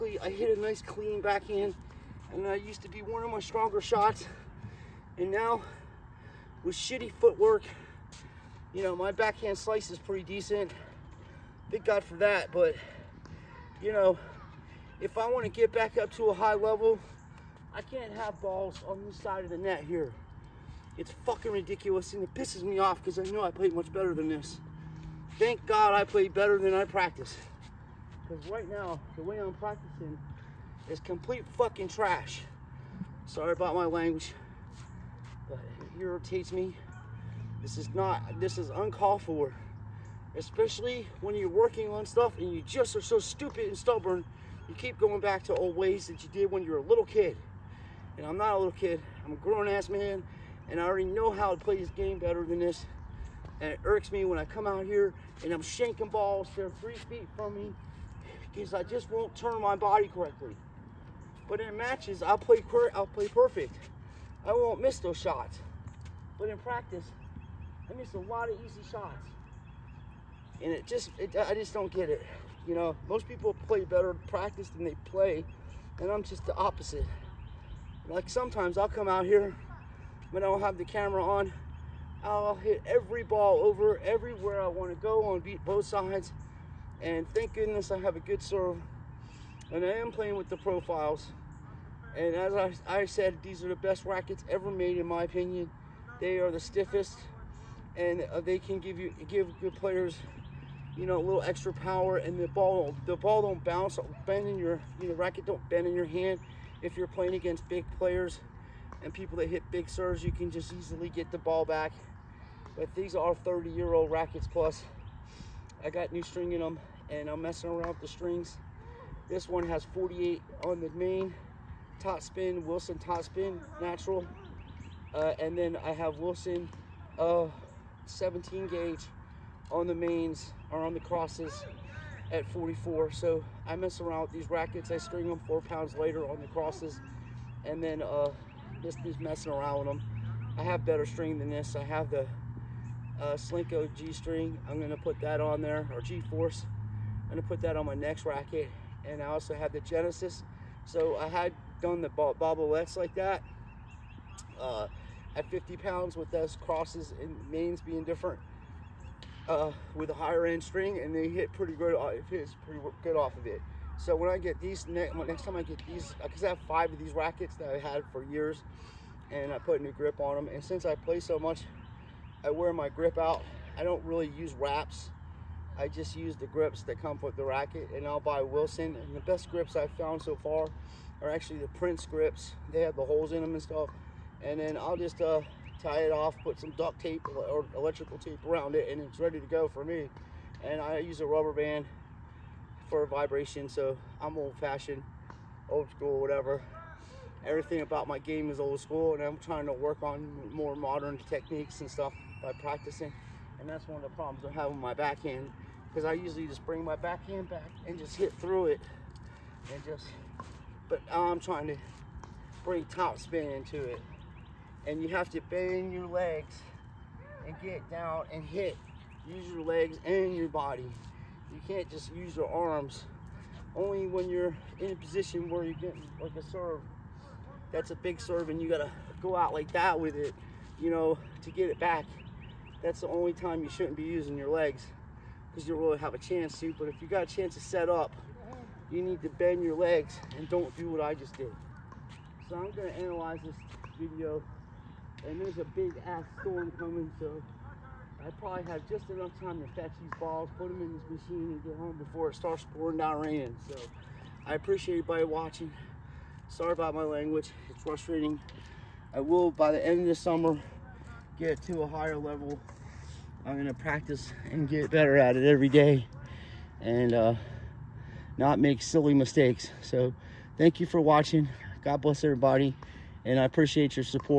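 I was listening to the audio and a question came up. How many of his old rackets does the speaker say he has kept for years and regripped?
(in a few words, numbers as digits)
5.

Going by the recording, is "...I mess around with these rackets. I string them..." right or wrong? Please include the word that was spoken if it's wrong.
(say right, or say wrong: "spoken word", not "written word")
right.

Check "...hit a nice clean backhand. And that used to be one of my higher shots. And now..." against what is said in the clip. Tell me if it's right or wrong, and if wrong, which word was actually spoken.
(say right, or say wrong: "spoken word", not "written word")
wrong: "stronger", not "higher".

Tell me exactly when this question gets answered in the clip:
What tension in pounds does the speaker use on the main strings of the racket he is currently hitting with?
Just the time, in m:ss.
1:59.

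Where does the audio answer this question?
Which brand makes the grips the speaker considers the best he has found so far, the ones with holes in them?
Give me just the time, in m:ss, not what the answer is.
3:01.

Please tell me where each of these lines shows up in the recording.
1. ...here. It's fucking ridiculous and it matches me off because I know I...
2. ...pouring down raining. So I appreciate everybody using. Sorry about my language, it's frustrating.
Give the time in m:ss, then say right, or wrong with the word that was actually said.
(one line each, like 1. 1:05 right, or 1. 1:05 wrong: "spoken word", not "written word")
1. 0:19 wrong: "pisses", not "matches"
2. 4:12 wrong: "watching", not "using".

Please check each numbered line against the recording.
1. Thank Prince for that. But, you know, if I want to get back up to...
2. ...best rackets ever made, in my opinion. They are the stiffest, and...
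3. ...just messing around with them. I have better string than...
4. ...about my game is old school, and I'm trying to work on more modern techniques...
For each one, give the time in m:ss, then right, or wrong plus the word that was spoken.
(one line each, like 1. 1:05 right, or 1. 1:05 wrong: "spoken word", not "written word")
1. 0:11 wrong: "God", not "Prince"
2. 1:33 right
3. 2:19 right
4. 3:17 right.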